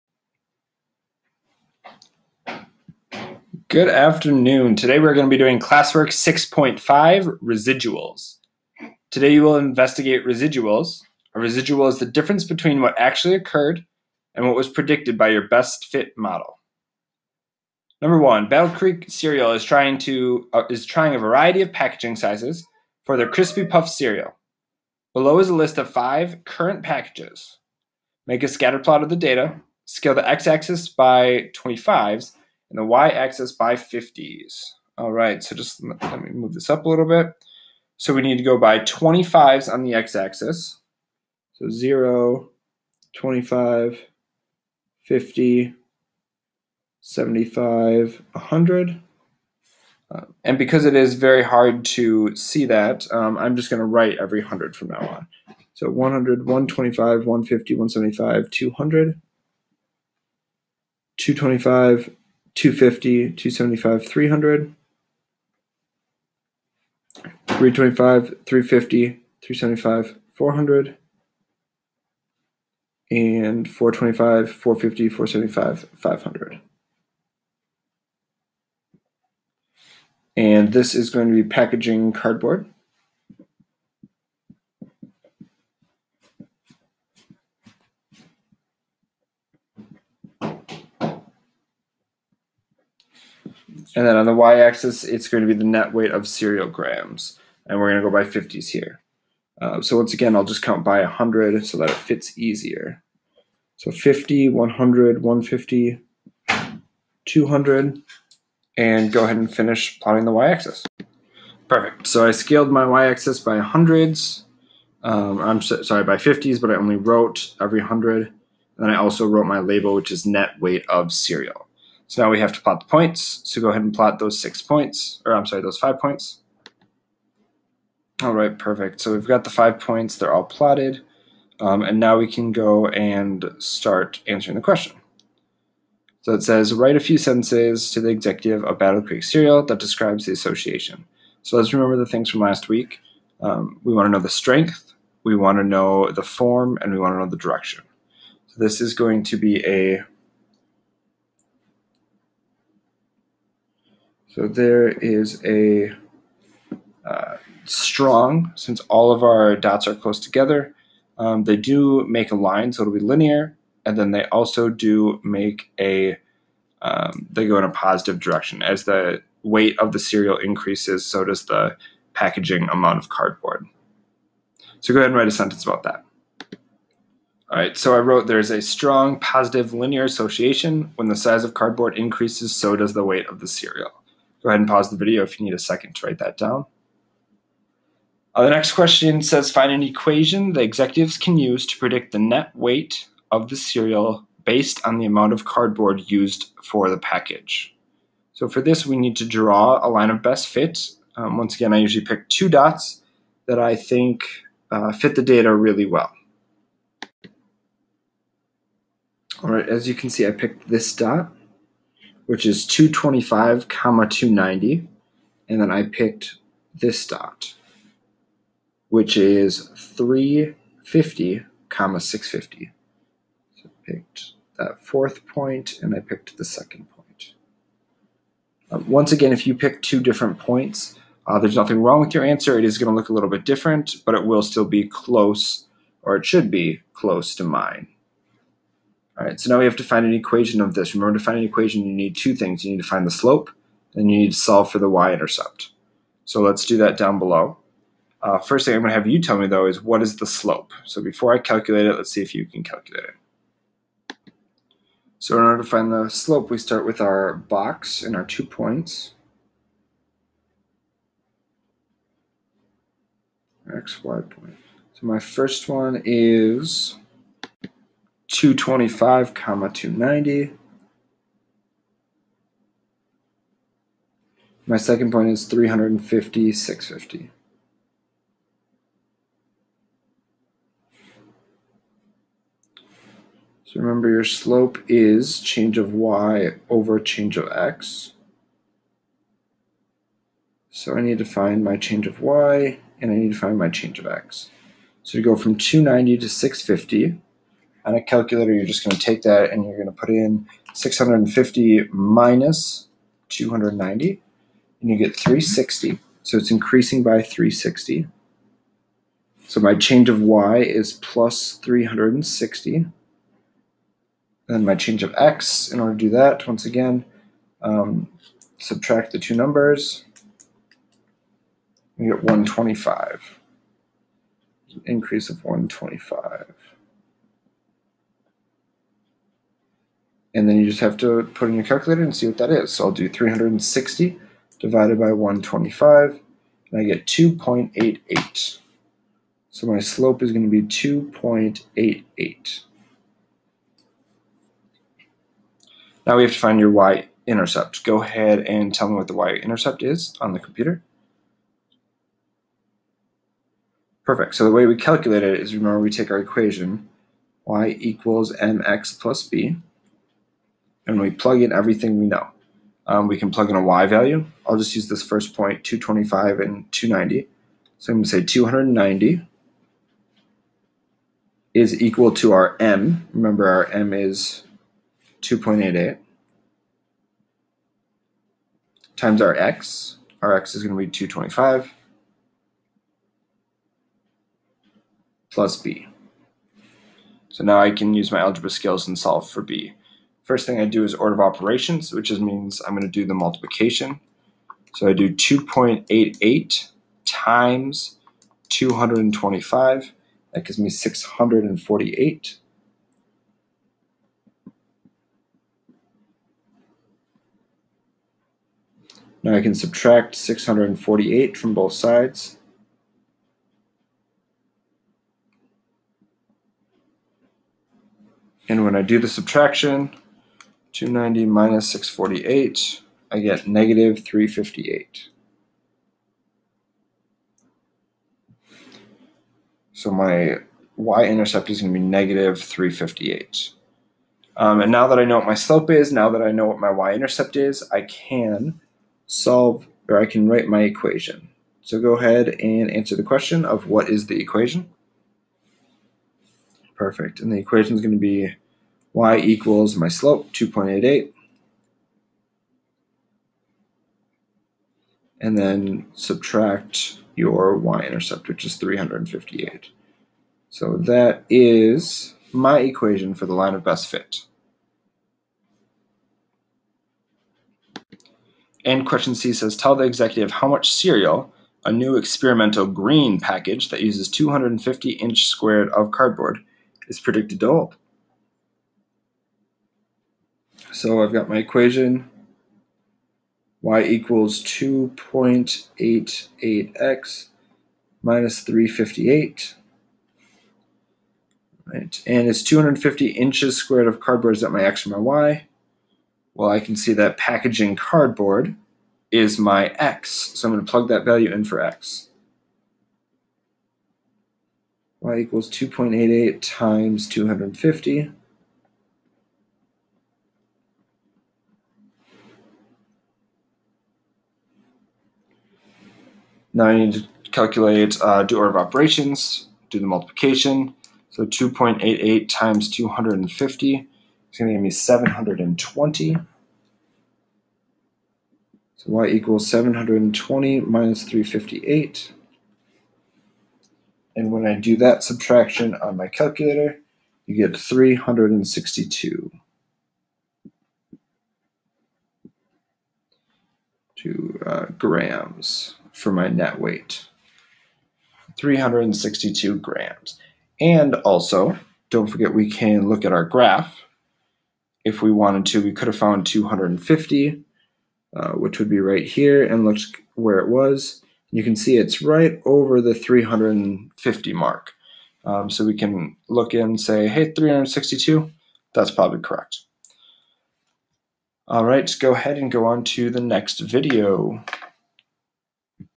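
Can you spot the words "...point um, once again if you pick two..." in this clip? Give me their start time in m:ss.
3:46.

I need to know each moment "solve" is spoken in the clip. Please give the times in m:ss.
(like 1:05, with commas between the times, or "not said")
4:04, 6:28, 7:19.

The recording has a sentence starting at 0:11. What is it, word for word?
A residual is the difference between what actually occurred and what was predicted by your best fit model.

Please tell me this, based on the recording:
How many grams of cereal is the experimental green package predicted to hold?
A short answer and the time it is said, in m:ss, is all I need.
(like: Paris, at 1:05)
362 grams, at 9:08.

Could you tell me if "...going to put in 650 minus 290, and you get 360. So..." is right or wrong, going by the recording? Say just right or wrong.
right.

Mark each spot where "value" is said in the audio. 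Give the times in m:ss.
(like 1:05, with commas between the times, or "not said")
6:03, 8:21.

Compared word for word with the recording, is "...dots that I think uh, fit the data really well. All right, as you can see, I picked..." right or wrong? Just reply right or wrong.
right.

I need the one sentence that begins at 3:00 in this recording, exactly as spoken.
When the size of cardboard increases, so does the weight of the cereal.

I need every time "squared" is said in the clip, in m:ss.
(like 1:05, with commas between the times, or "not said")
7:55, 8:13.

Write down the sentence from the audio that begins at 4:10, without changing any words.
So before I calculate it, let's see if you can calculate it.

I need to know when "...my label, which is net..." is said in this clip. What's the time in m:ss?
1:59.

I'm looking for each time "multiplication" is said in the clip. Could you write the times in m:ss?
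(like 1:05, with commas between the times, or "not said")
6:33, 8:39.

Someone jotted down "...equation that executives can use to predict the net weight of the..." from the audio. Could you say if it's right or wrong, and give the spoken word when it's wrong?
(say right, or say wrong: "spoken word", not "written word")
right.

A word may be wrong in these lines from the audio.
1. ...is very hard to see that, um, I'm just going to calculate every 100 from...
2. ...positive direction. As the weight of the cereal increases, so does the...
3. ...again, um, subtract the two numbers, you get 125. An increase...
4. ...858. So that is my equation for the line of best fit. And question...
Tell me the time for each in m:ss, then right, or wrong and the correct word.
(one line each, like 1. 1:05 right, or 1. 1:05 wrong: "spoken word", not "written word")
1. 0:50 wrong: "write", not "calculate"
2. 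2:47 right
3. 5:16 right
4. 7:38 wrong: "358", not "858".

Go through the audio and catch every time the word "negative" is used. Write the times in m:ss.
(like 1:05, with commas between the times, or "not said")
7:03, 7:11.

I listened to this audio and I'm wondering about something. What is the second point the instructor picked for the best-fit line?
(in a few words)
350, 650.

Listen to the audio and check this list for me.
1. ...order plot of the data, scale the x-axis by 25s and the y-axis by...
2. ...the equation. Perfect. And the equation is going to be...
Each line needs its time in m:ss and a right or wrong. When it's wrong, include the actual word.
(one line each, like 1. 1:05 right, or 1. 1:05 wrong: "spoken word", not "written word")
1. 0:28 wrong: "scatter", not "order"
2. 7:24 right.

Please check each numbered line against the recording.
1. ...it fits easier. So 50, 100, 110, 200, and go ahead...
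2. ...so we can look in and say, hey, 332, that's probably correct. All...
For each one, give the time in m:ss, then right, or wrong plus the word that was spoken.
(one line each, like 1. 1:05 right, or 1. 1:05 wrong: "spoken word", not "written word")
1. 1:41 wrong: "150", not "110"
2. 9:25 wrong: "362", not "332".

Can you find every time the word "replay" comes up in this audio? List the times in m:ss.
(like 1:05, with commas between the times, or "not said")
not said.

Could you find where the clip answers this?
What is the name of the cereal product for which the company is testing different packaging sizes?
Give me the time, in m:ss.
0:23.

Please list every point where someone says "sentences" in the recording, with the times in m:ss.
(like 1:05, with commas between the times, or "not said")
2:17, 2:55.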